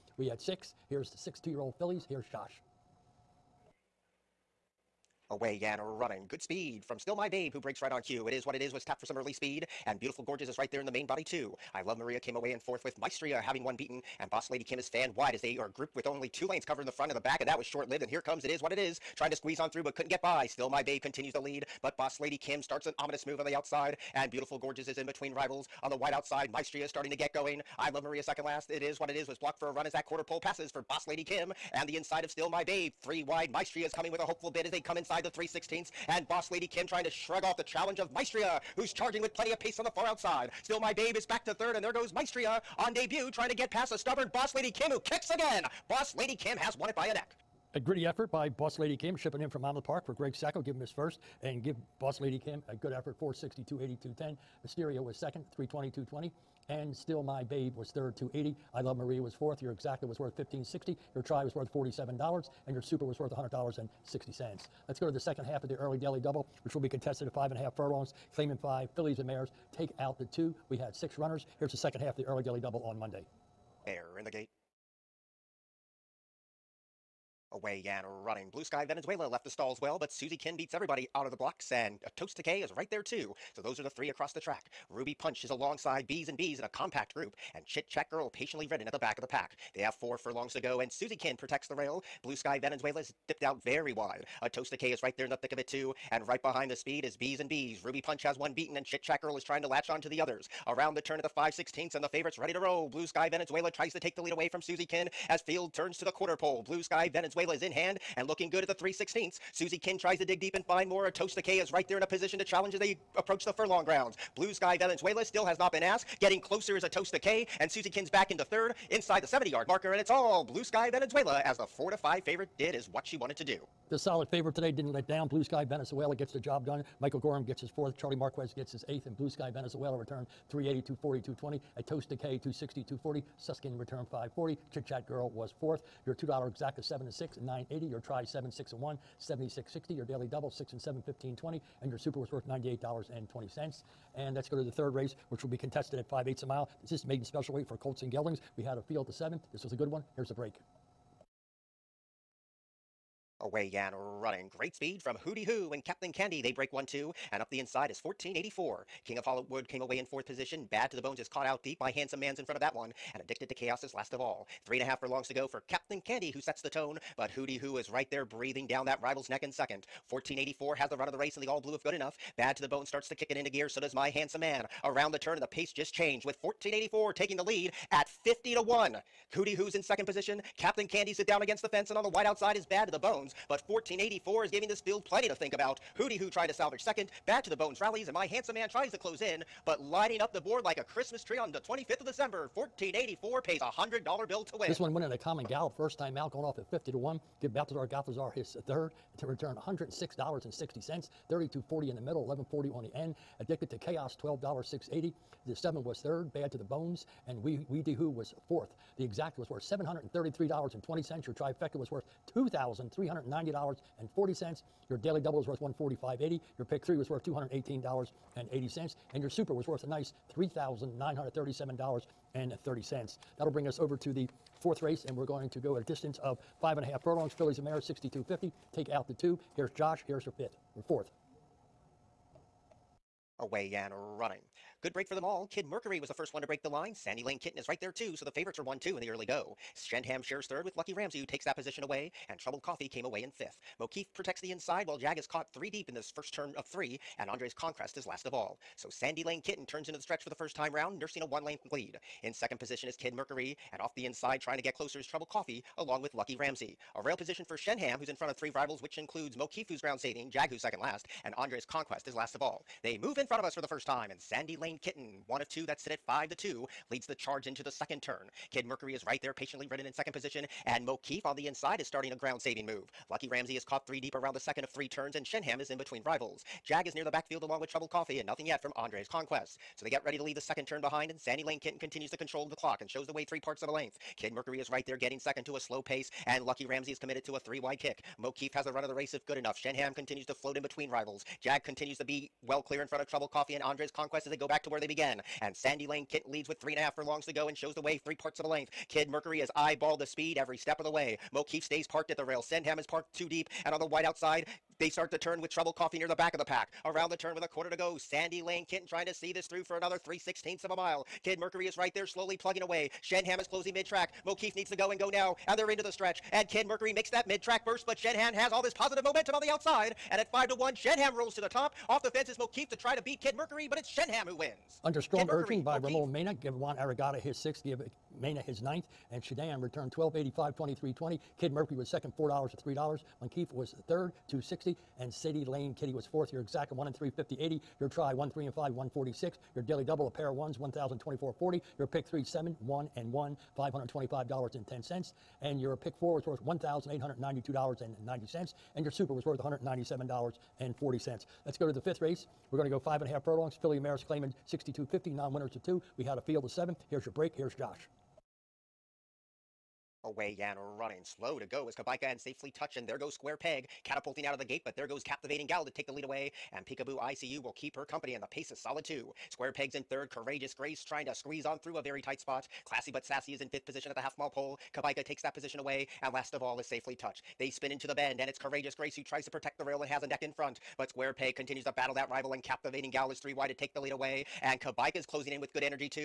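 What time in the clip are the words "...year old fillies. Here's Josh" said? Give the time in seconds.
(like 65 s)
1 s.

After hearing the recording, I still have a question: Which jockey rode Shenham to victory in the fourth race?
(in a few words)
Ramon Mena.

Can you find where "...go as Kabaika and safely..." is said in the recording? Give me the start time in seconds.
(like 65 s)
361 s.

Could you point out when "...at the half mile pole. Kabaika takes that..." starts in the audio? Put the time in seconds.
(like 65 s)
373 s.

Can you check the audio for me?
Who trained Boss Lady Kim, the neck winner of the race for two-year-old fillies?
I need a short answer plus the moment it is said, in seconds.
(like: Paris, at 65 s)
Greg Sacco, at 50 s.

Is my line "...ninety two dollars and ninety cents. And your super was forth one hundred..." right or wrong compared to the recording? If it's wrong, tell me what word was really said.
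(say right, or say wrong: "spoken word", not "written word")
wrong: "worth", not "forth".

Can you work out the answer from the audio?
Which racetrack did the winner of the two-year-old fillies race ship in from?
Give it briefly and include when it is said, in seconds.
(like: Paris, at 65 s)
Monmouth Park, at 49 s.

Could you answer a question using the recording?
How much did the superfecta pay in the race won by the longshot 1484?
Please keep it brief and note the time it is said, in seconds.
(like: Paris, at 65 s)
$3,937.30, at 220 s.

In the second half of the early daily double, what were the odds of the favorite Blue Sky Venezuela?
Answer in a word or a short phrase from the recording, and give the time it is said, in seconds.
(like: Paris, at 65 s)
4-5, at 121 s.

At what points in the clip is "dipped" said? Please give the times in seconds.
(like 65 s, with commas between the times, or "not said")
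93 s.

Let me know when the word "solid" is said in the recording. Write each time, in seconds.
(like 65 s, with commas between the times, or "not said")
123 s, 368 s.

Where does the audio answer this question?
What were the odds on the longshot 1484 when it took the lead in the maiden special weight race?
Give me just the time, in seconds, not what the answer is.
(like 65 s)
178 s.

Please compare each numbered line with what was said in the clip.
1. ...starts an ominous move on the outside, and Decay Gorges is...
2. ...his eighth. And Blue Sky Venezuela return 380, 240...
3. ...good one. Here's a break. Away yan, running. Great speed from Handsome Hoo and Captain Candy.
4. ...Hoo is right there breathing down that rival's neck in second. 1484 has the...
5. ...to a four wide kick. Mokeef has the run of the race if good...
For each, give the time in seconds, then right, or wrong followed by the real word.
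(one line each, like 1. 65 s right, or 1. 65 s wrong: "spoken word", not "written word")
1. 22 s wrong: "Beautiful", not "Decay"
2. 128 s right
3. 149 s wrong: "Hooty", not "Handsome"
4. 167 s right
5. 287 s wrong: "three", not "four".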